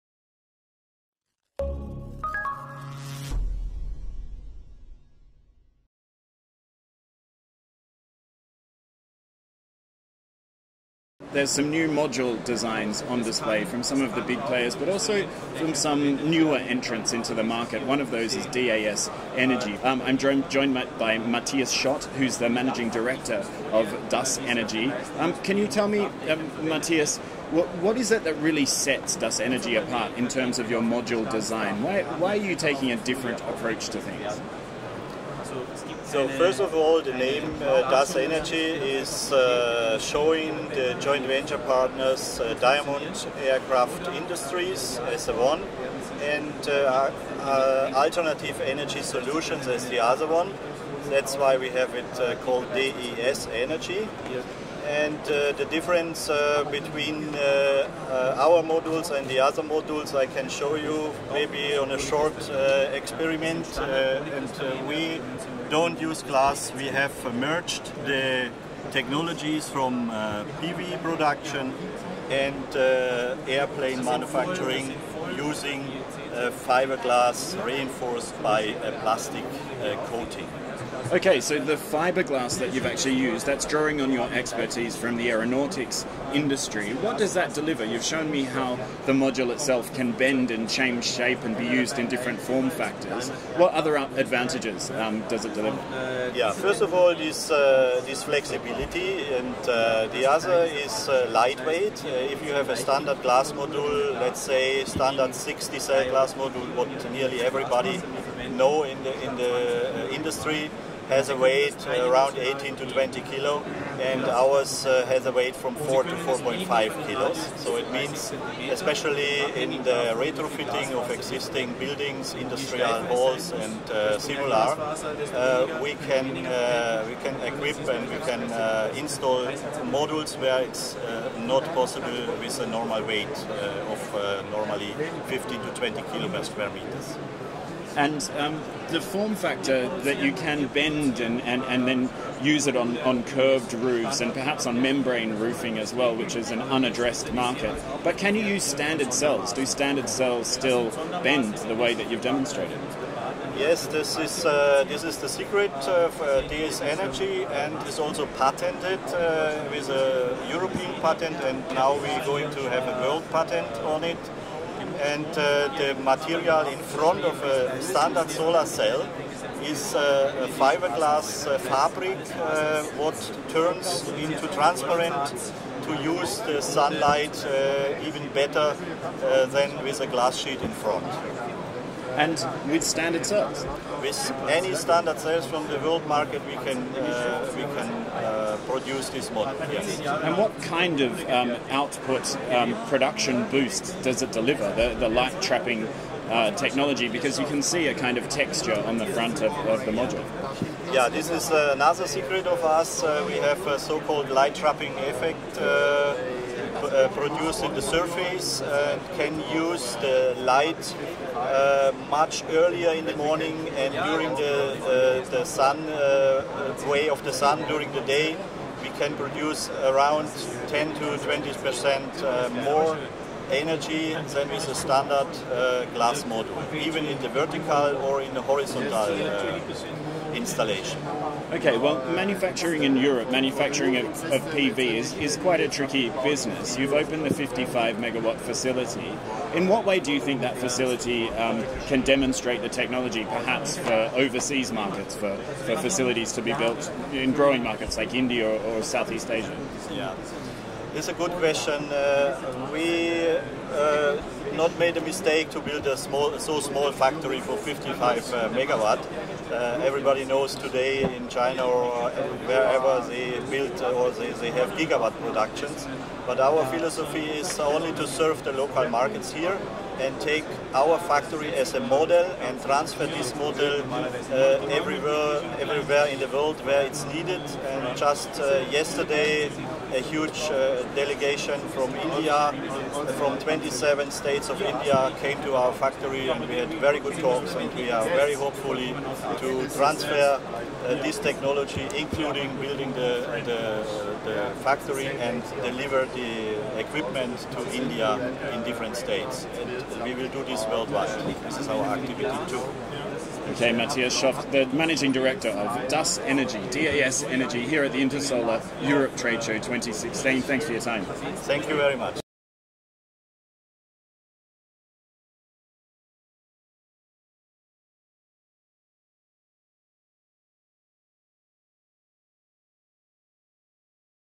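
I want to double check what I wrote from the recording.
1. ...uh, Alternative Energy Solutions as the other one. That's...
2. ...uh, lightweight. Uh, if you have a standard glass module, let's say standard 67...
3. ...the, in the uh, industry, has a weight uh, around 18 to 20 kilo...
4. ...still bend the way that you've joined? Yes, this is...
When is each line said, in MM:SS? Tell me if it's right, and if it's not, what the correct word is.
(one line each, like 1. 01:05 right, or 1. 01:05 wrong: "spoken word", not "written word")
1. 00:47 right
2. 01:41 wrong: "60", not "67"
3. 01:49 right
4. 02:30 wrong: "demonstrated", not "joined".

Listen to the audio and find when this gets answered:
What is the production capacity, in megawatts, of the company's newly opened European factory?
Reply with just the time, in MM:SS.
03:57.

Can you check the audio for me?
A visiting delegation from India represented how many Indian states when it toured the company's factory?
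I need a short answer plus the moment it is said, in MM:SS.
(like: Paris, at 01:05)
27, at 04:43.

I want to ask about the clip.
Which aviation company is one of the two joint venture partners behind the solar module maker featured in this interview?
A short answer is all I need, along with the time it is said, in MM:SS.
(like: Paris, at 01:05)
Diamond Aircraft Industries, at 00:42.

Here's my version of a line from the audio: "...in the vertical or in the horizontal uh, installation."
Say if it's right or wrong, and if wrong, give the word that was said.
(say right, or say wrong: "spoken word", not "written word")
right.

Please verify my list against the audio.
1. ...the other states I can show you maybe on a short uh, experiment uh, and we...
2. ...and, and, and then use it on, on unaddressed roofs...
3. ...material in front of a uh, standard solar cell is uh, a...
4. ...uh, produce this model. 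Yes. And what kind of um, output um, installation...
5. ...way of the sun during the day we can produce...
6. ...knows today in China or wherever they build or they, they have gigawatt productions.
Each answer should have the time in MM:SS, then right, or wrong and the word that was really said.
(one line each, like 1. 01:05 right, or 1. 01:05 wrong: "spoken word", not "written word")
1. 00:59 wrong: "modules", not "states"
2. 02:21 wrong: "curved", not "unaddressed"
3. 02:46 right
4. 03:08 wrong: "production", not "installation"
5. 03:36 right
6. 04:20 right.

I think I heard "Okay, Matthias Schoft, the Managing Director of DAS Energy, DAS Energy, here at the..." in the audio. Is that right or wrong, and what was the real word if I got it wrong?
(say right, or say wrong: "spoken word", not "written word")
right.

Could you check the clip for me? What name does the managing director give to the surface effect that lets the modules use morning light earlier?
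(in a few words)
light trapping effect.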